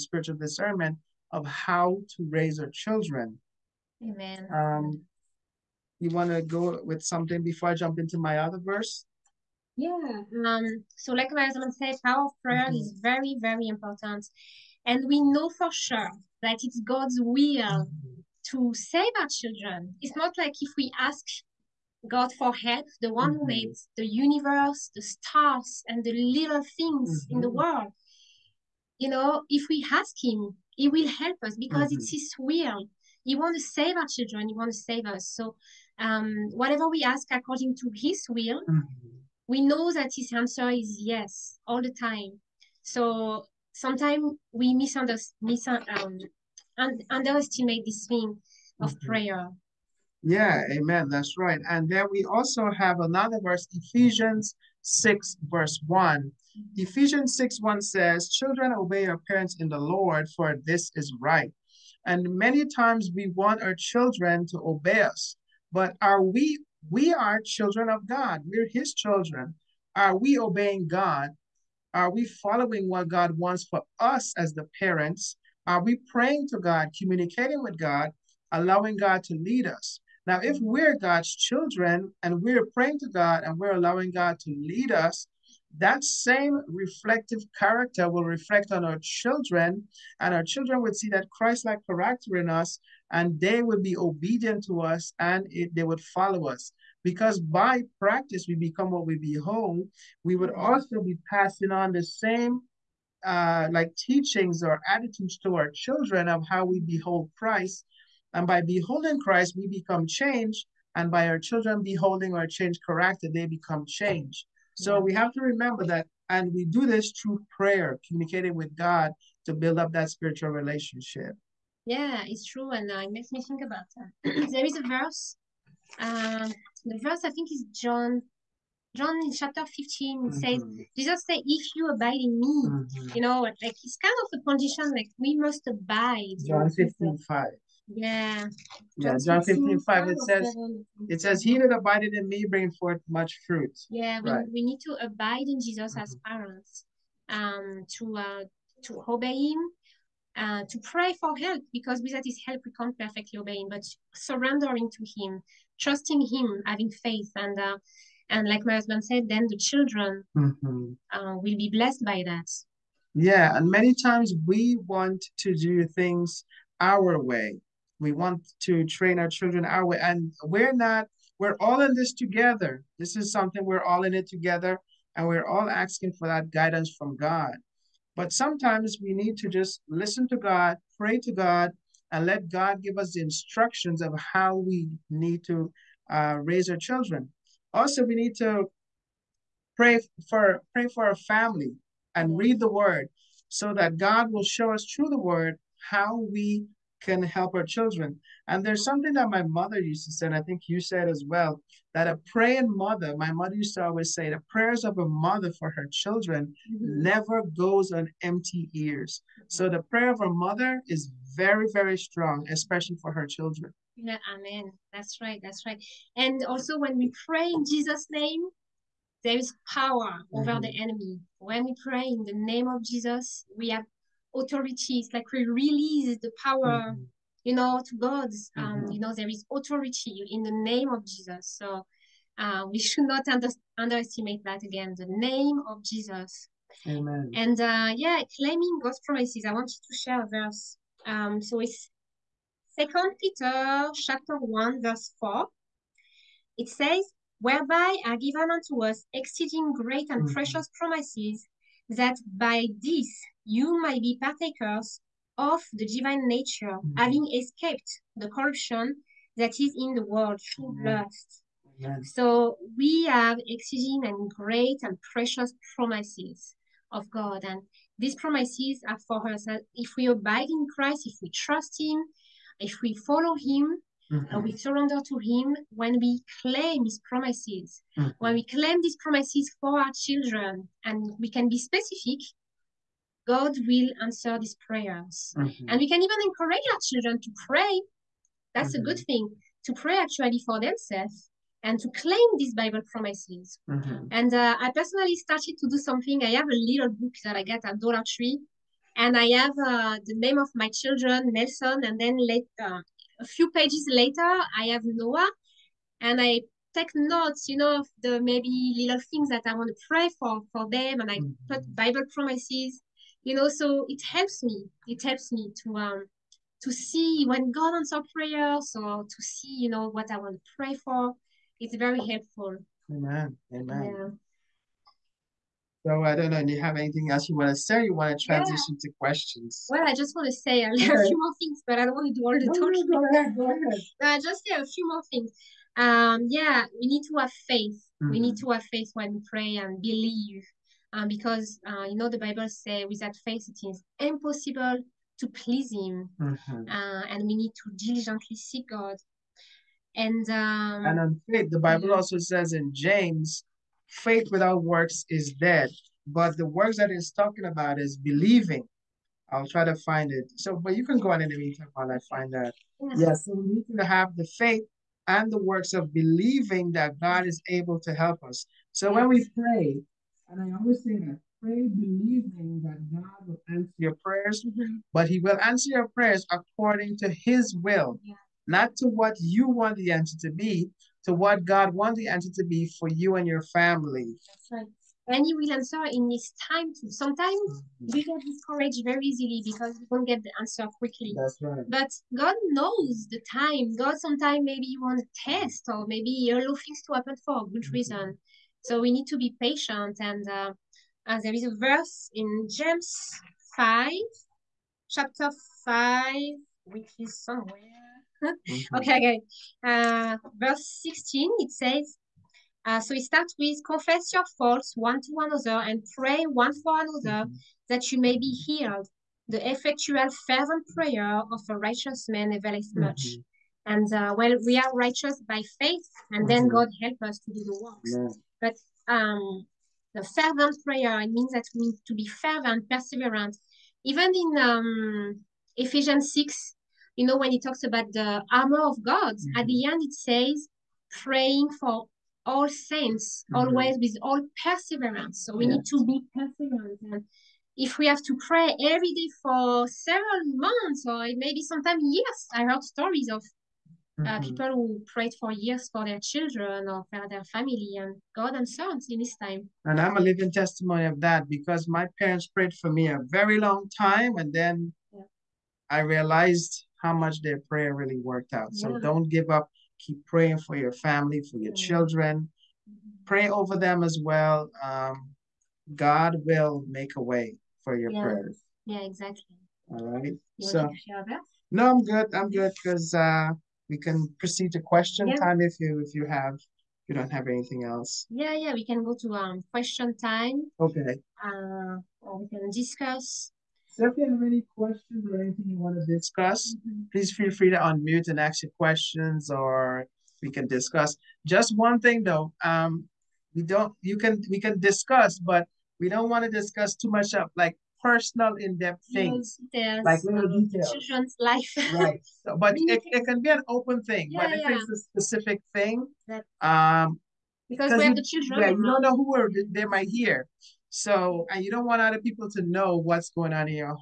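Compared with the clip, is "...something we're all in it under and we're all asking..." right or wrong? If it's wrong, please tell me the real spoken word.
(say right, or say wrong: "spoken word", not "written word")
wrong: "together", not "under".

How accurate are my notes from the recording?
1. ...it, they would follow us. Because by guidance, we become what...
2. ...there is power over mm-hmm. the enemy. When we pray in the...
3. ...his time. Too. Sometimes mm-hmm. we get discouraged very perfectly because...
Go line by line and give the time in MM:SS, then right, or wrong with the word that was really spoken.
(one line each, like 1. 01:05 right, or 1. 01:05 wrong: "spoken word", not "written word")
1. 01:35 wrong: "practice", not "guidance"
2. 03:39 right
3. 06:26 wrong: "easily", not "perfectly".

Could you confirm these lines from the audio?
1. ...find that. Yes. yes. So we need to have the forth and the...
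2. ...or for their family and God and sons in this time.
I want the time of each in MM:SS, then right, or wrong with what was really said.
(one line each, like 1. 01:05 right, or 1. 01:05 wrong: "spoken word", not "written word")
1. 06:02 wrong: "faith", not "forth"
2. 07:36 right.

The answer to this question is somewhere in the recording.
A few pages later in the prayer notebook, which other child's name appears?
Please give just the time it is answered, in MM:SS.
05:04.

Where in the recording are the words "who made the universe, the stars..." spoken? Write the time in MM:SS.
00:23.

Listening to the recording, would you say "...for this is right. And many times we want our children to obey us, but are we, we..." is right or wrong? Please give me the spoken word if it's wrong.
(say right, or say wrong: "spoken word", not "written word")
right.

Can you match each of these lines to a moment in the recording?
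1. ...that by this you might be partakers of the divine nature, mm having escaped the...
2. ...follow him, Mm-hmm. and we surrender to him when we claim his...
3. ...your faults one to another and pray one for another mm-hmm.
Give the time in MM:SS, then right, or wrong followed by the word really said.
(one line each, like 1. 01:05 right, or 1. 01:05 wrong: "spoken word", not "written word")
1. 04:11 right
2. 04:32 right
3. 06:54 right.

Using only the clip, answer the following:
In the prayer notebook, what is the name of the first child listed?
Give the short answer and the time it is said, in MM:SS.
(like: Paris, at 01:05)
Nelson, at 05:01.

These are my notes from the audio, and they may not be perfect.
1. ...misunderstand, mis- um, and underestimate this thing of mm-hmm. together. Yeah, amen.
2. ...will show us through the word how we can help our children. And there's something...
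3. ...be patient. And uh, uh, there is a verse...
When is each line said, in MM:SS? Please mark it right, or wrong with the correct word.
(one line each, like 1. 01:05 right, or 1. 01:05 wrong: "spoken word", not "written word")
1. 00:44 wrong: "prayer", not "together"
2. 03:14 right
3. 06:39 right.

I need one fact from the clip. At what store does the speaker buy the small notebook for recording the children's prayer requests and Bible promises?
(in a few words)
Dollar Tree.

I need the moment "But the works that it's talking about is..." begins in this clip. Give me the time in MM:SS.
05:56.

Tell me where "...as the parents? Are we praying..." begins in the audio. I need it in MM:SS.
01:14.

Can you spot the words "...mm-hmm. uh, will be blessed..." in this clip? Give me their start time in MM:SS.
02:40.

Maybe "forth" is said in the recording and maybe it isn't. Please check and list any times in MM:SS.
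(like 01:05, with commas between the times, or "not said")
02:22.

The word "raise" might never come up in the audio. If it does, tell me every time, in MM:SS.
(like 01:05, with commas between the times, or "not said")
00:02, 03:06.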